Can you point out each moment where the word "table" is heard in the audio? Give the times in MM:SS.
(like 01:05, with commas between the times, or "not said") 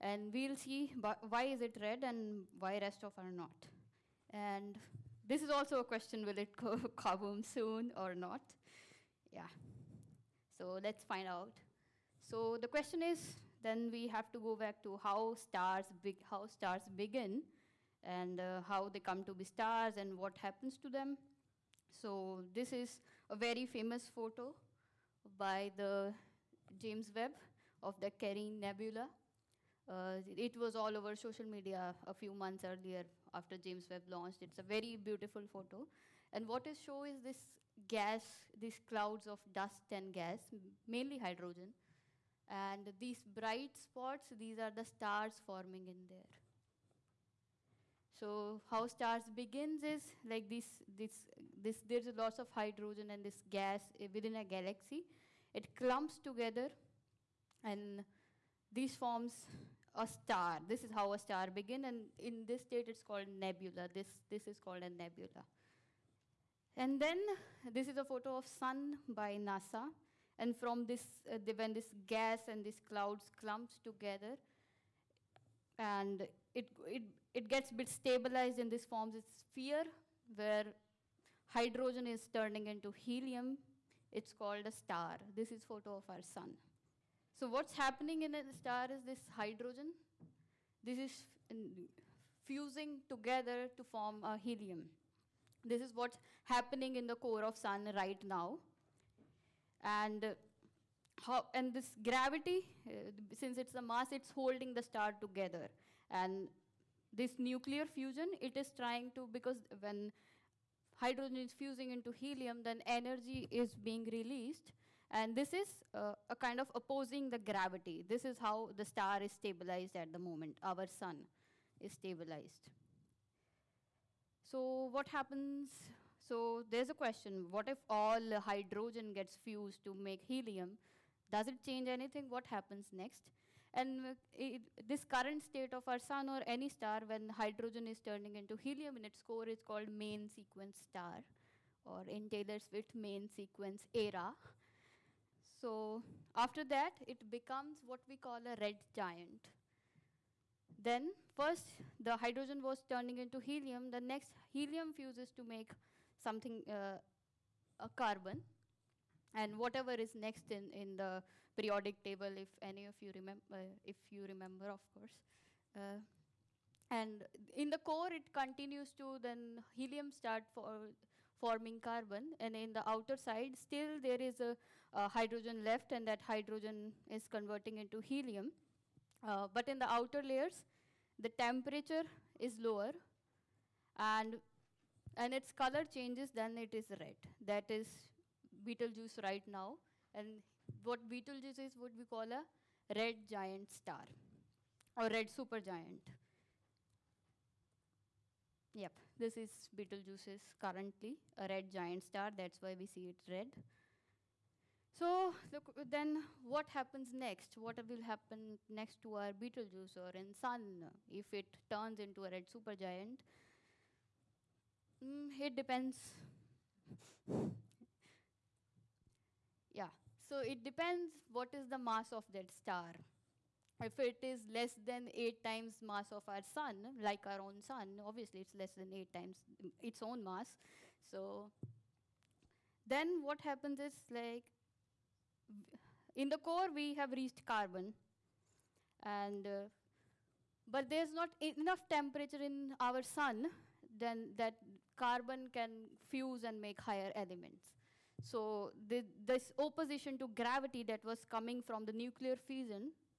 02:42.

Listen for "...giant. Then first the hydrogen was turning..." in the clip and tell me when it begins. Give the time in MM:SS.
02:28.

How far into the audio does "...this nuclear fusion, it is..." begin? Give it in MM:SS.
01:47.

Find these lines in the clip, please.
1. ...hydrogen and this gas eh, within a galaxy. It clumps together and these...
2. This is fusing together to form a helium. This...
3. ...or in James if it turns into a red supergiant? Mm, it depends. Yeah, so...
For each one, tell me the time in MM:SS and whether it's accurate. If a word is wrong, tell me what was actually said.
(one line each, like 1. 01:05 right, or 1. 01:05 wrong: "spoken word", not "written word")
1. 00:52 right
2. 01:30 right
3. 03:29 wrong: "Sun", not "James".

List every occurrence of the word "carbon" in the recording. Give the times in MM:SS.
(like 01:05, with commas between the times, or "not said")
02:37, 02:51, 03:57, 04:04.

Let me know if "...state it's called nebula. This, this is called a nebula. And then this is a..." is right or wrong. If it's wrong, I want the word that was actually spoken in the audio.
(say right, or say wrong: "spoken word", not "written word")
right.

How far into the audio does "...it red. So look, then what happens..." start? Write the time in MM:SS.
03:23.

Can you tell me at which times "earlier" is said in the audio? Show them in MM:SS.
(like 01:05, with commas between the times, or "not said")
00:32.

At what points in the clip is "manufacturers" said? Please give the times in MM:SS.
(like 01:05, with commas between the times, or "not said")
not said.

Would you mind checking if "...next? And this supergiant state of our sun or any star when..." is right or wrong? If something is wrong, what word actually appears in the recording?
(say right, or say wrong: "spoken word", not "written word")
wrong: "current", not "supergiant".